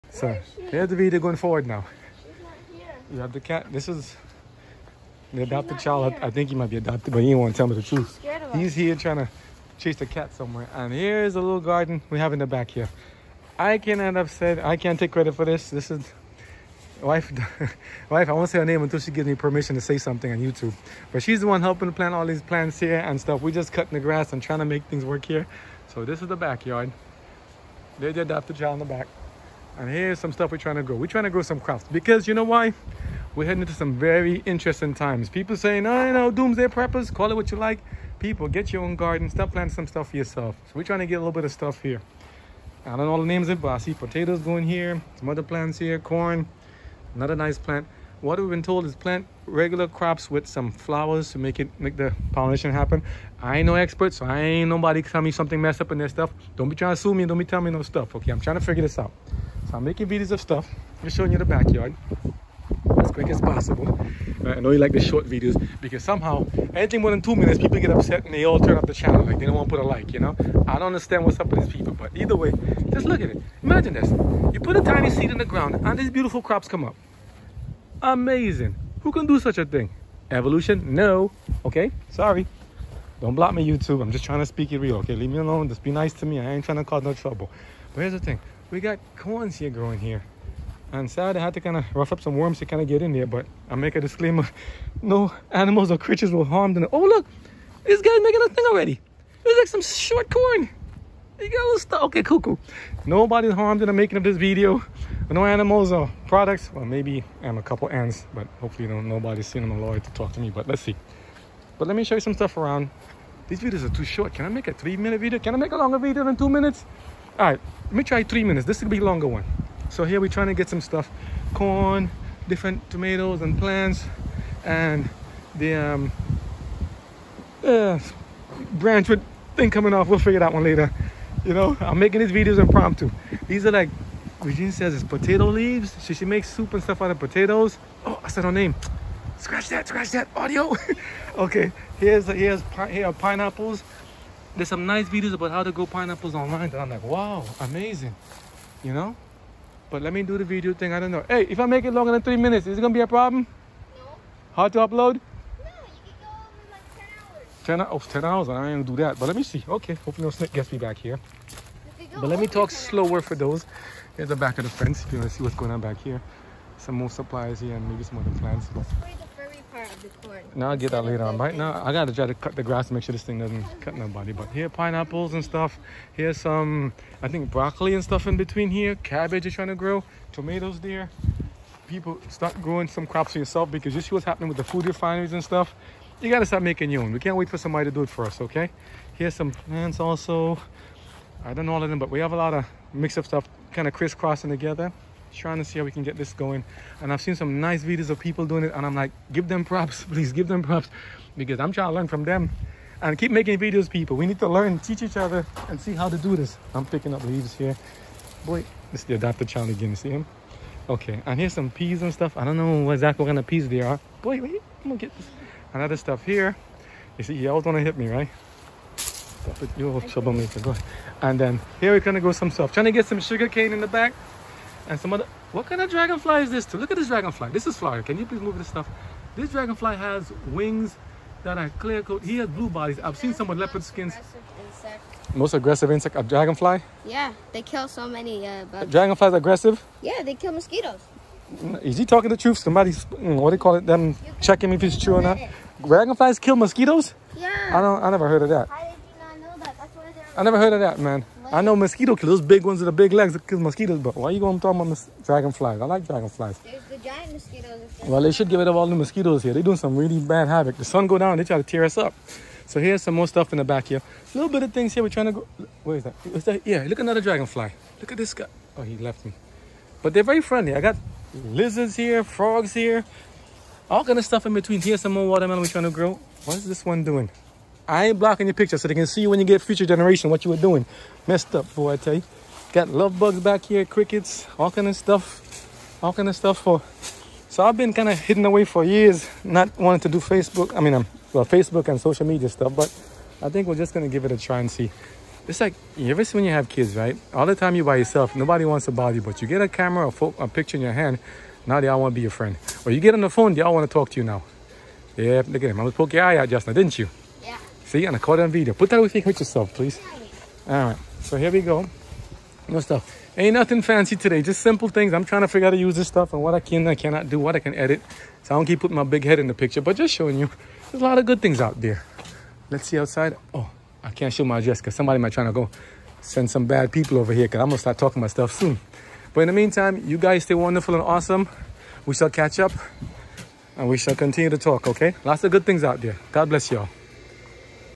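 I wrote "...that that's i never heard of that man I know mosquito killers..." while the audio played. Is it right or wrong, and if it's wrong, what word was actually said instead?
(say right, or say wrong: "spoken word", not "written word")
right.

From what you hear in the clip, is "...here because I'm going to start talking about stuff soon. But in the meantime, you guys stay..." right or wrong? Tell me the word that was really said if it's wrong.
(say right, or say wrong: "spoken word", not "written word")
right.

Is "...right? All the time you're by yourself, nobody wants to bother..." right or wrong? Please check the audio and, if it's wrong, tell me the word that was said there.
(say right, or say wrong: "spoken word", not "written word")
right.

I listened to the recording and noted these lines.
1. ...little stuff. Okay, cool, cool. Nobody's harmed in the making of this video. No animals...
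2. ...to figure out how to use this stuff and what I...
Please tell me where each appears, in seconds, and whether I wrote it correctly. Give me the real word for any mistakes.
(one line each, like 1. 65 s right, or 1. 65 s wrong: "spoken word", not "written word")
1. 101 s right
2. 315 s right.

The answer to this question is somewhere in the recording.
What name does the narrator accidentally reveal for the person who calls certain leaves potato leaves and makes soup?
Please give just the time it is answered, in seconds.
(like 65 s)
134 s.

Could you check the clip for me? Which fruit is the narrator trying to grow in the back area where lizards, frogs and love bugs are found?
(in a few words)
Watermelon.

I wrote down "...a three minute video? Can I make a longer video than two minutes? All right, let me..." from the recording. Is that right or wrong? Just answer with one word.
right.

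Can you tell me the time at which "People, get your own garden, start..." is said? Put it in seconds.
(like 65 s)
38 s.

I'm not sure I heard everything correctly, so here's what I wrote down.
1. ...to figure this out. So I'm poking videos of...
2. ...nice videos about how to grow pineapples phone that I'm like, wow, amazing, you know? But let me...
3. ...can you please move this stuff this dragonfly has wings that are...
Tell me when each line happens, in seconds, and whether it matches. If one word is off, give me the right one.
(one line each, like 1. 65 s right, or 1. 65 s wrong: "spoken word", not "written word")
1. 58 s wrong: "making", not "poking"
2. 144 s wrong: "online", not "phone"
3. 228 s right.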